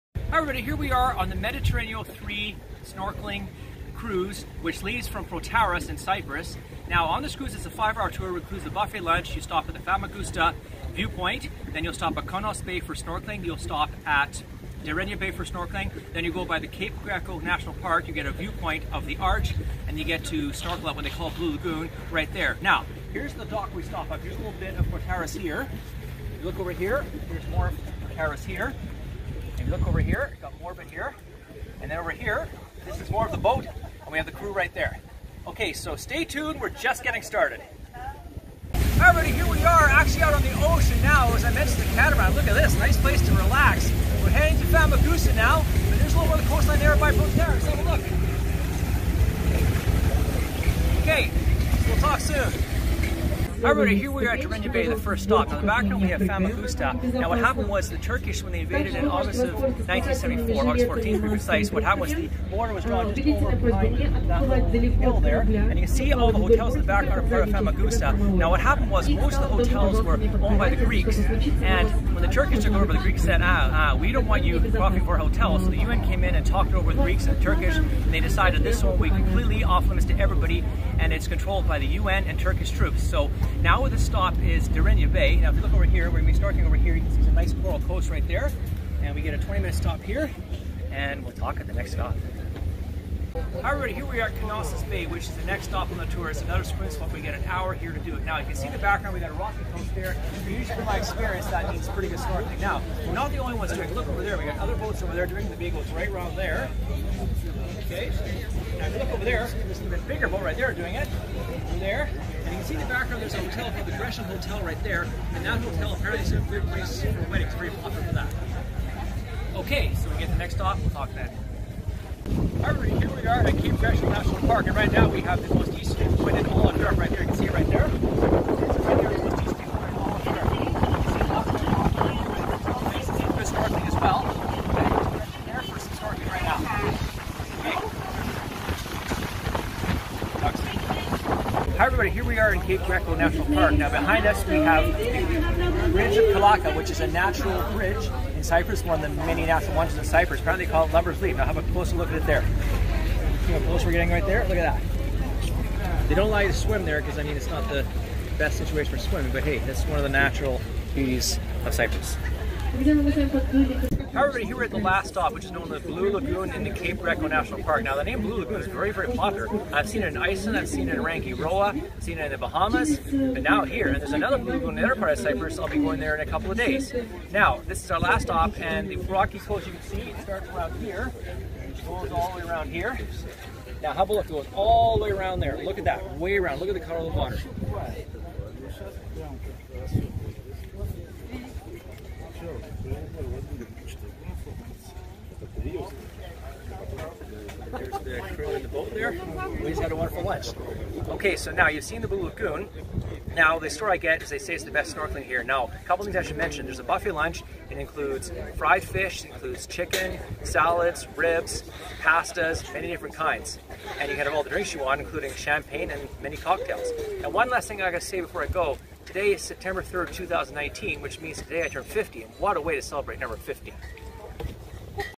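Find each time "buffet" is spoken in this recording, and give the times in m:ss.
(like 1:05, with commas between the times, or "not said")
0:08, 3:26.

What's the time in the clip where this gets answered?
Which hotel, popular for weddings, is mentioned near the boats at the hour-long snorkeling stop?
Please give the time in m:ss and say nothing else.
1:53.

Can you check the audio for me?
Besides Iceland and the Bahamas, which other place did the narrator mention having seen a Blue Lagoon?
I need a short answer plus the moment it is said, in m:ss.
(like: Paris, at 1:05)
Rangiroa, at 2:51.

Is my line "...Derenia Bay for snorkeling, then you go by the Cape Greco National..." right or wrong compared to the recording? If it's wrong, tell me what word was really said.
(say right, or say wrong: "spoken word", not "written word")
right.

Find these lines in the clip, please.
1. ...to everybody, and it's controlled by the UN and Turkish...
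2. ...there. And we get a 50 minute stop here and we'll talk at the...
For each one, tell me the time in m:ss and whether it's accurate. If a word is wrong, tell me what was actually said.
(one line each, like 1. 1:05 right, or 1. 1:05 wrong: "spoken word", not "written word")
1. 1:20 right
2. 1:28 wrong: "20", not "50".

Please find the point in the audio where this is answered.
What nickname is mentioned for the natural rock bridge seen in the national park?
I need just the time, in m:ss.
2:30.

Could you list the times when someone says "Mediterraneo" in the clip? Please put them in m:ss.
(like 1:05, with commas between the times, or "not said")
0:01.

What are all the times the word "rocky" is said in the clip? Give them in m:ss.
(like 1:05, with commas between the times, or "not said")
1:39, 2:58.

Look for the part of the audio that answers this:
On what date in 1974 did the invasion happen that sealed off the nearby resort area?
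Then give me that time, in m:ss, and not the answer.
1:00.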